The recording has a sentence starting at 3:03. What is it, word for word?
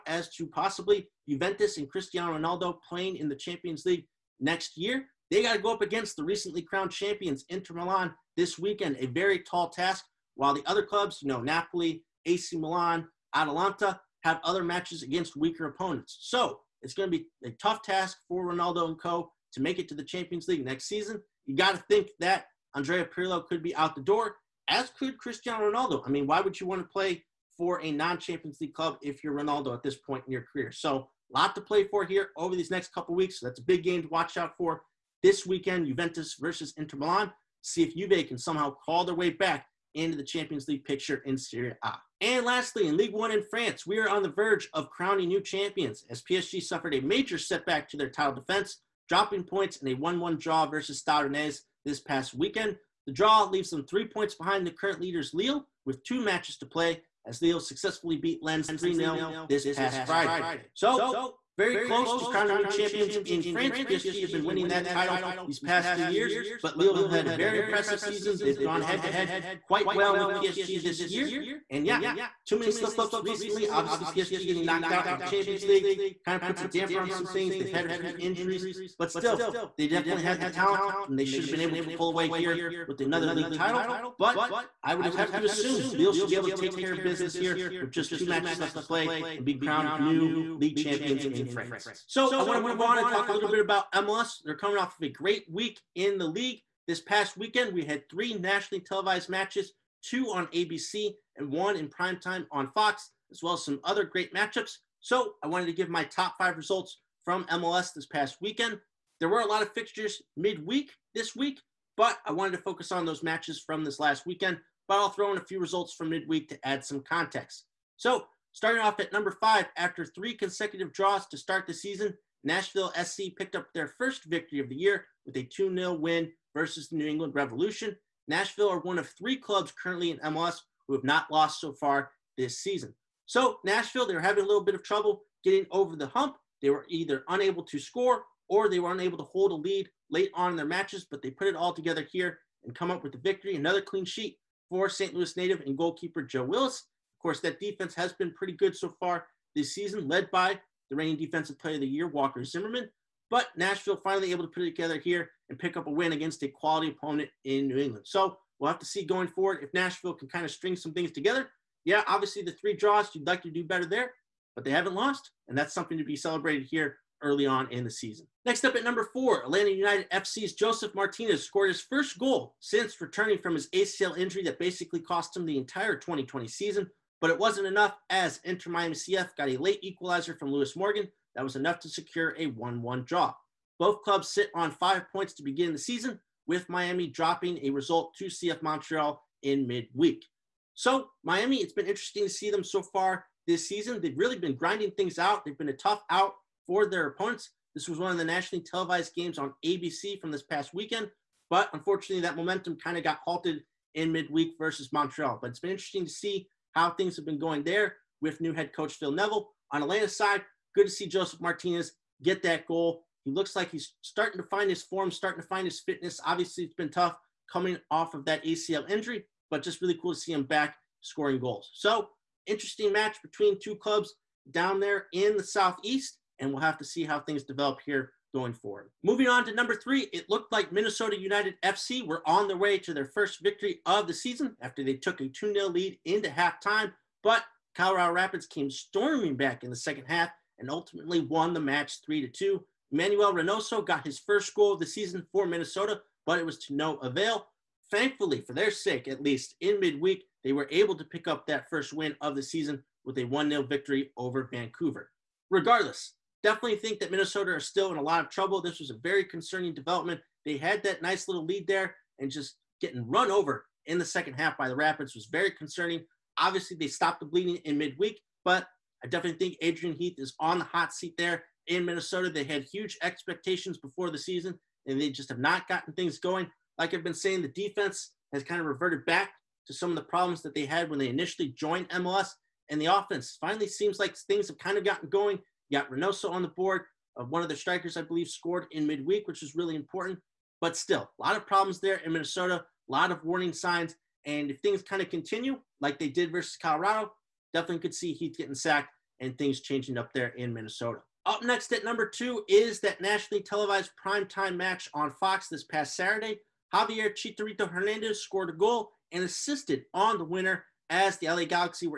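Both clubs sit on five points to begin the season, with Miami dropping a result to CF Montreal in midweek.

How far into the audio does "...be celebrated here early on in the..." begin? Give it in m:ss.
2:46.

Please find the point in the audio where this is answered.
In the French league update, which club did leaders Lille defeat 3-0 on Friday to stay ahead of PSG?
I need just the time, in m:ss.
0:58.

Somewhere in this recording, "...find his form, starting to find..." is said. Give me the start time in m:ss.
3:34.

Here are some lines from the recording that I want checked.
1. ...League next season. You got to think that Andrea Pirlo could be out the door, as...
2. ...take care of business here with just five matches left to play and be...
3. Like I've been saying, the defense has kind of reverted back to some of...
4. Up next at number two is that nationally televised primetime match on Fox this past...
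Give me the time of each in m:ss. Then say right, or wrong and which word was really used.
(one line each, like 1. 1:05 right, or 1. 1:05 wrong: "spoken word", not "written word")
1. 0:20 right
2. 1:26 wrong: "two", not "five"
3. 4:36 right
4. 5:01 right.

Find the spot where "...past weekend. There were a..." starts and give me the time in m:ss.
1:48.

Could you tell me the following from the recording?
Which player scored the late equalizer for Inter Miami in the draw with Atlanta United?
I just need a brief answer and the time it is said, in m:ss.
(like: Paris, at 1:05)
Lewis Morgan, at 3:00.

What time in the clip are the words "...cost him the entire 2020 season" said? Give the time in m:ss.
2:54.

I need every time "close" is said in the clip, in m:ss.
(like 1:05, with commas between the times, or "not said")
1:01.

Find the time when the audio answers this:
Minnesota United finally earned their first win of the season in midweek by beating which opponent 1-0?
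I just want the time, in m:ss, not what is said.
4:14.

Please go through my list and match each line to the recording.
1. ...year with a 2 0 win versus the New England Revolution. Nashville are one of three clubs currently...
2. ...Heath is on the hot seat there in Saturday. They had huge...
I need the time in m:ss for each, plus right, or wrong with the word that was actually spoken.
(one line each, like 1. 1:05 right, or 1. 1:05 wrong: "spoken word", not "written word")
1. 2:04 right
2. 4:29 wrong: "Minnesota", not "Saturday".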